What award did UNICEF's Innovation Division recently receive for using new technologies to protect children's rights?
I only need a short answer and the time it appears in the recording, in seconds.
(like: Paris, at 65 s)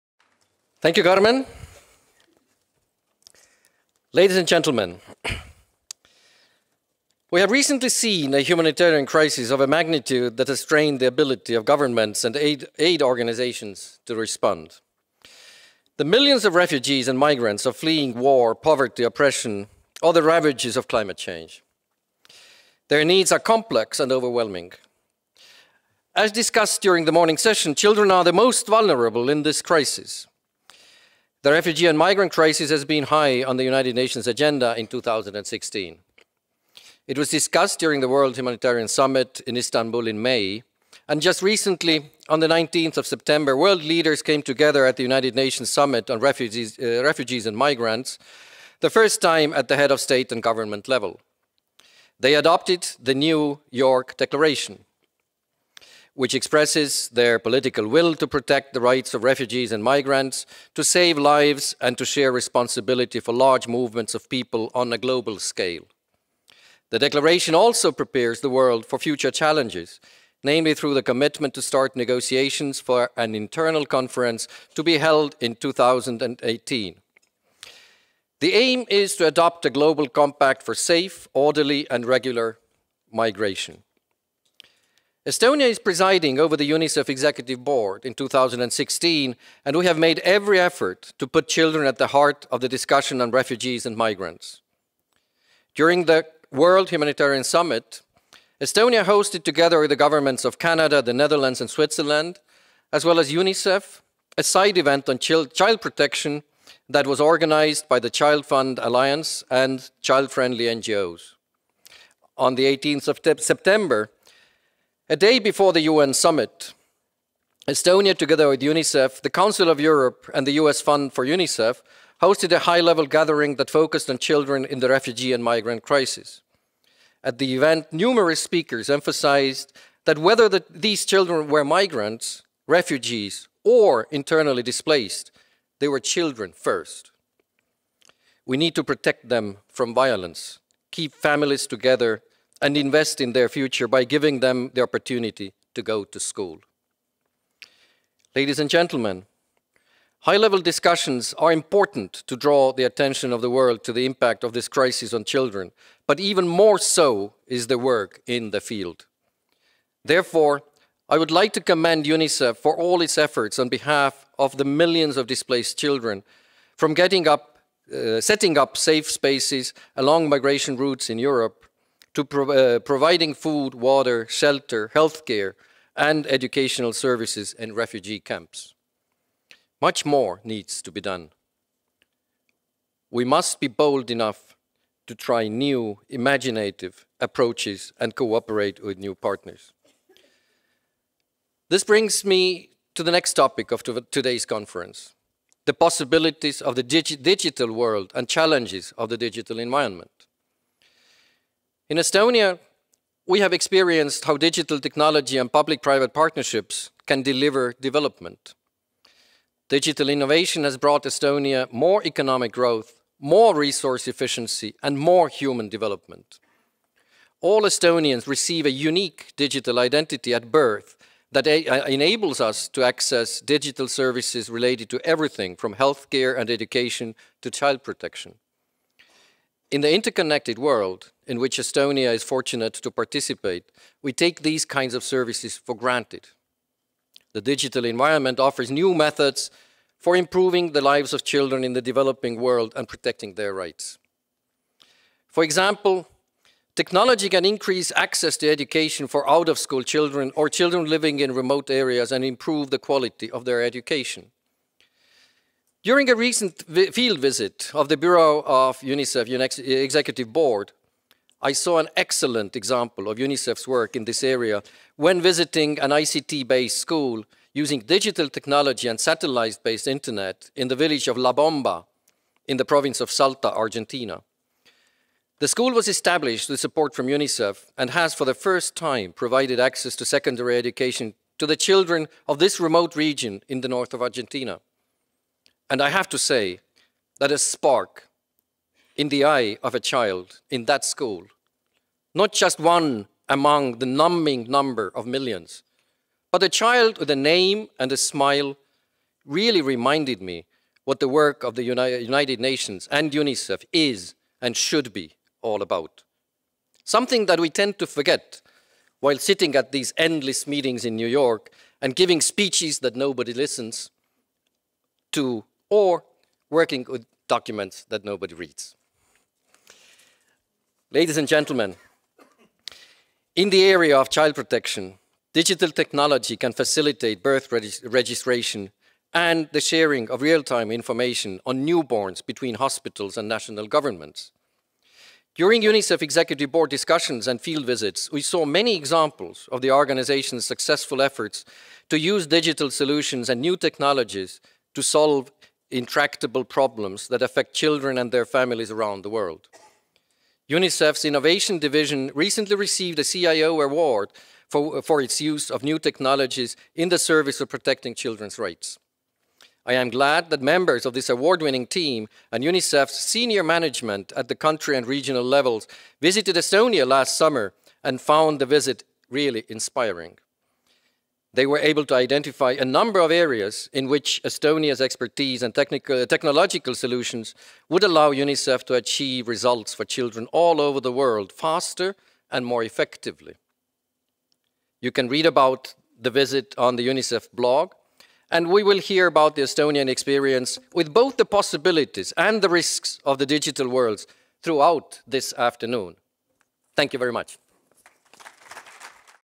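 CIO award, at 353 s.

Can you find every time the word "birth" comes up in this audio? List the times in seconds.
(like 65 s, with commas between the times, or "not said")
220 s, 327 s.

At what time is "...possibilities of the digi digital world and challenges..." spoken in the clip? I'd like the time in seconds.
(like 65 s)
195 s.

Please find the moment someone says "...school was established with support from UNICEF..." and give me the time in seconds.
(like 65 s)
275 s.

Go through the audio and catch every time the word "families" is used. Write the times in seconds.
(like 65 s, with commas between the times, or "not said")
141 s, 348 s.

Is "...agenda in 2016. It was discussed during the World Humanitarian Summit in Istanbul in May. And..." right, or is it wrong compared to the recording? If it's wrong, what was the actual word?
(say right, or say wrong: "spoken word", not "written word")
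right.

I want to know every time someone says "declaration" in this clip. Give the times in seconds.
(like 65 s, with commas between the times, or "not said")
54 s, 66 s.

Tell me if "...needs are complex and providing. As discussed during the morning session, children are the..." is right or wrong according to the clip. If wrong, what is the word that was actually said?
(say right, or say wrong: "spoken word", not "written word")
wrong: "overwhelming", not "providing".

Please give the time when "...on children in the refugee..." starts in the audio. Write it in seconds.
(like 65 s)
124 s.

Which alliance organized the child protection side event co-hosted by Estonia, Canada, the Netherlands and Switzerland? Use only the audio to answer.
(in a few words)
ChildFund Alliance.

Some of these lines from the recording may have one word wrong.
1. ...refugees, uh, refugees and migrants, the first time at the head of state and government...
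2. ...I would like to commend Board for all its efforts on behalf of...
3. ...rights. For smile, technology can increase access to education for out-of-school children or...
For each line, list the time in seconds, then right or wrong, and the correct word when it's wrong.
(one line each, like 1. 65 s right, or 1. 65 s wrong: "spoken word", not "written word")
1. 46 s right
2. 161 s wrong: "UNICEF", not "Board"
3. 243 s wrong: "example", not "smile".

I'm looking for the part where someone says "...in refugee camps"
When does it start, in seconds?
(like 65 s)
177 s.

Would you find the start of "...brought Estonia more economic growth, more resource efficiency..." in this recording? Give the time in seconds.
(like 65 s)
210 s.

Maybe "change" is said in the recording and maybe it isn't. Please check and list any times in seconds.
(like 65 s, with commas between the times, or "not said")
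21 s.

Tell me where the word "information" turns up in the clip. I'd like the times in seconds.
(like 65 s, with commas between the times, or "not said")
330 s.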